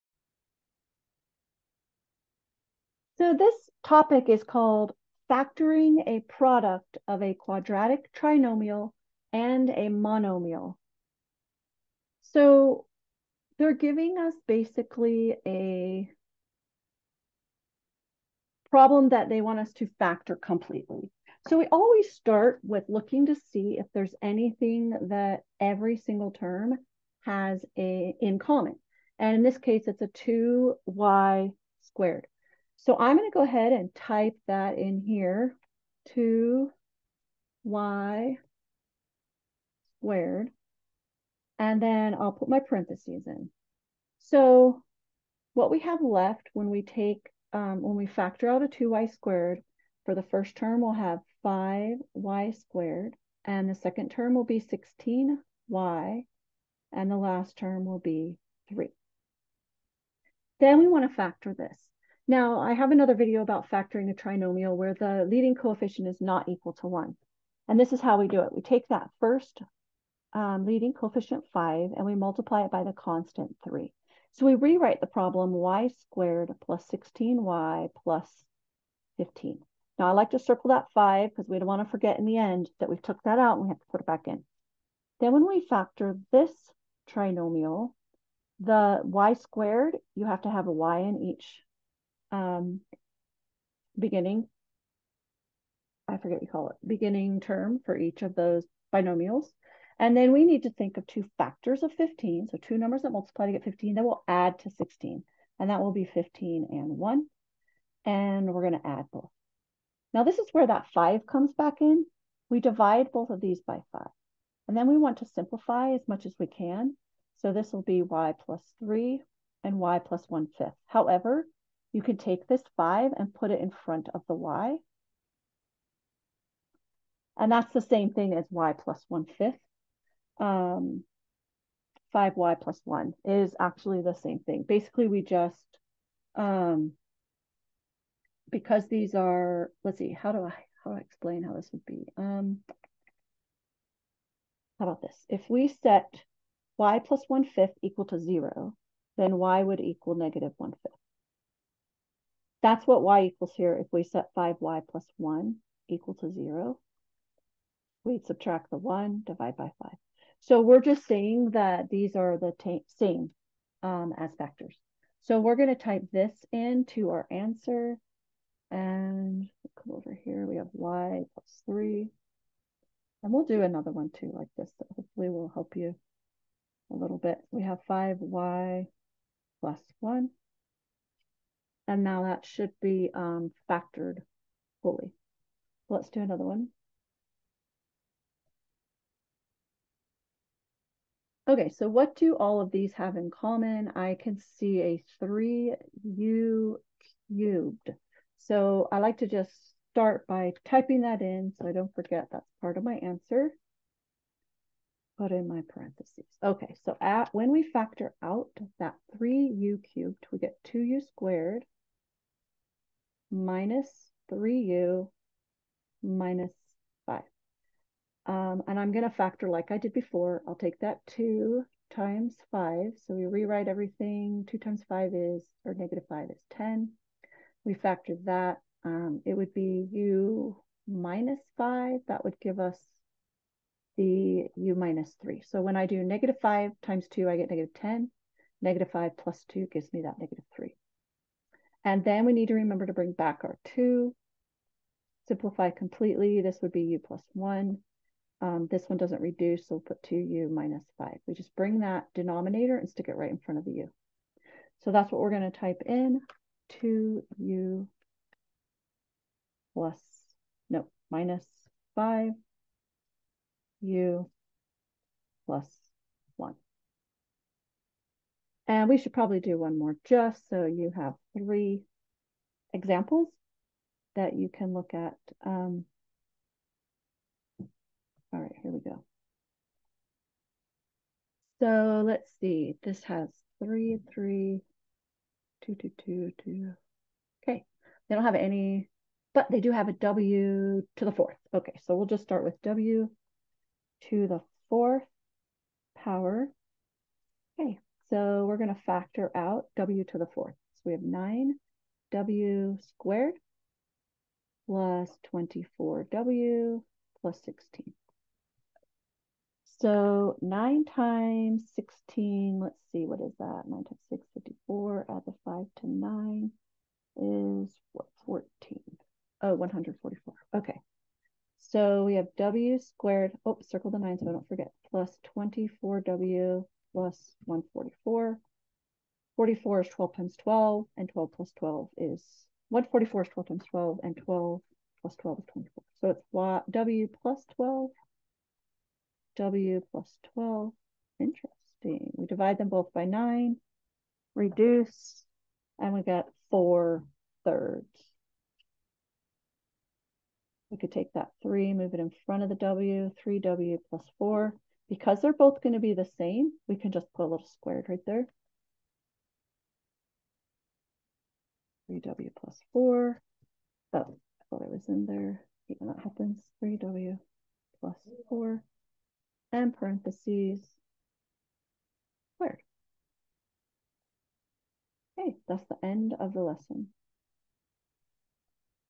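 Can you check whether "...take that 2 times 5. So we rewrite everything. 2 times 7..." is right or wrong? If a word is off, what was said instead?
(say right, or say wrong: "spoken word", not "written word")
wrong: "5", not "7".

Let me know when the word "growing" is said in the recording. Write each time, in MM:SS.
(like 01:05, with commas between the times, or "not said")
not said.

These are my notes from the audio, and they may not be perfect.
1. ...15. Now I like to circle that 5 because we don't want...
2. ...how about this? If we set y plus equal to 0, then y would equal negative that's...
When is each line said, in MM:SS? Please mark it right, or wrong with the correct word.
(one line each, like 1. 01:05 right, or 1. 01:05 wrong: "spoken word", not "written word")
1. 01:19 right
2. 02:24 right.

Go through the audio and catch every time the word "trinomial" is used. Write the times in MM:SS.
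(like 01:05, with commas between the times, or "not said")
00:08, 01:04, 01:27.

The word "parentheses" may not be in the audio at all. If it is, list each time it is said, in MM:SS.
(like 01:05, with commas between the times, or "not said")
00:42, 03:25, 06:09.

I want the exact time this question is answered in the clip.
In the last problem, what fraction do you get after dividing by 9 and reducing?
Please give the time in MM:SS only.
05:46.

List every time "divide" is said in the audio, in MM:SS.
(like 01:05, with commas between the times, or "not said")
01:52, 02:39, 05:42.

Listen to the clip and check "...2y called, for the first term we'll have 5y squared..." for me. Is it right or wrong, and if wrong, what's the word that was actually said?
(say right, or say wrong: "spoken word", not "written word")
wrong: "squared", not "called".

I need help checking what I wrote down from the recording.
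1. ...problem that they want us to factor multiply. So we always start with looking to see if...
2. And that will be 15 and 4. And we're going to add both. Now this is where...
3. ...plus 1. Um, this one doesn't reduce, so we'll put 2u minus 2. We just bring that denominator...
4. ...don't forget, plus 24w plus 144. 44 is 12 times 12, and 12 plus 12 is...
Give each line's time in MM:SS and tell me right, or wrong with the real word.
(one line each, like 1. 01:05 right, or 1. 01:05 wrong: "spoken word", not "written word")
1. 00:18 wrong: "completely", not "multiply"
2. 01:45 wrong: "1", not "4"
3. 04:06 wrong: "5", not "2"
4. 05:24 right.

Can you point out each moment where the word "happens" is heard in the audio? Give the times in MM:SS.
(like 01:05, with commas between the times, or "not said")
06:06.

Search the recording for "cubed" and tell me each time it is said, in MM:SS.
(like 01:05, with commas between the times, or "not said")
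03:17, 03:29.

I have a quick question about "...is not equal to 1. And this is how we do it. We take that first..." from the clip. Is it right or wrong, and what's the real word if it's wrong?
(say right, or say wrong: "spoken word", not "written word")
right.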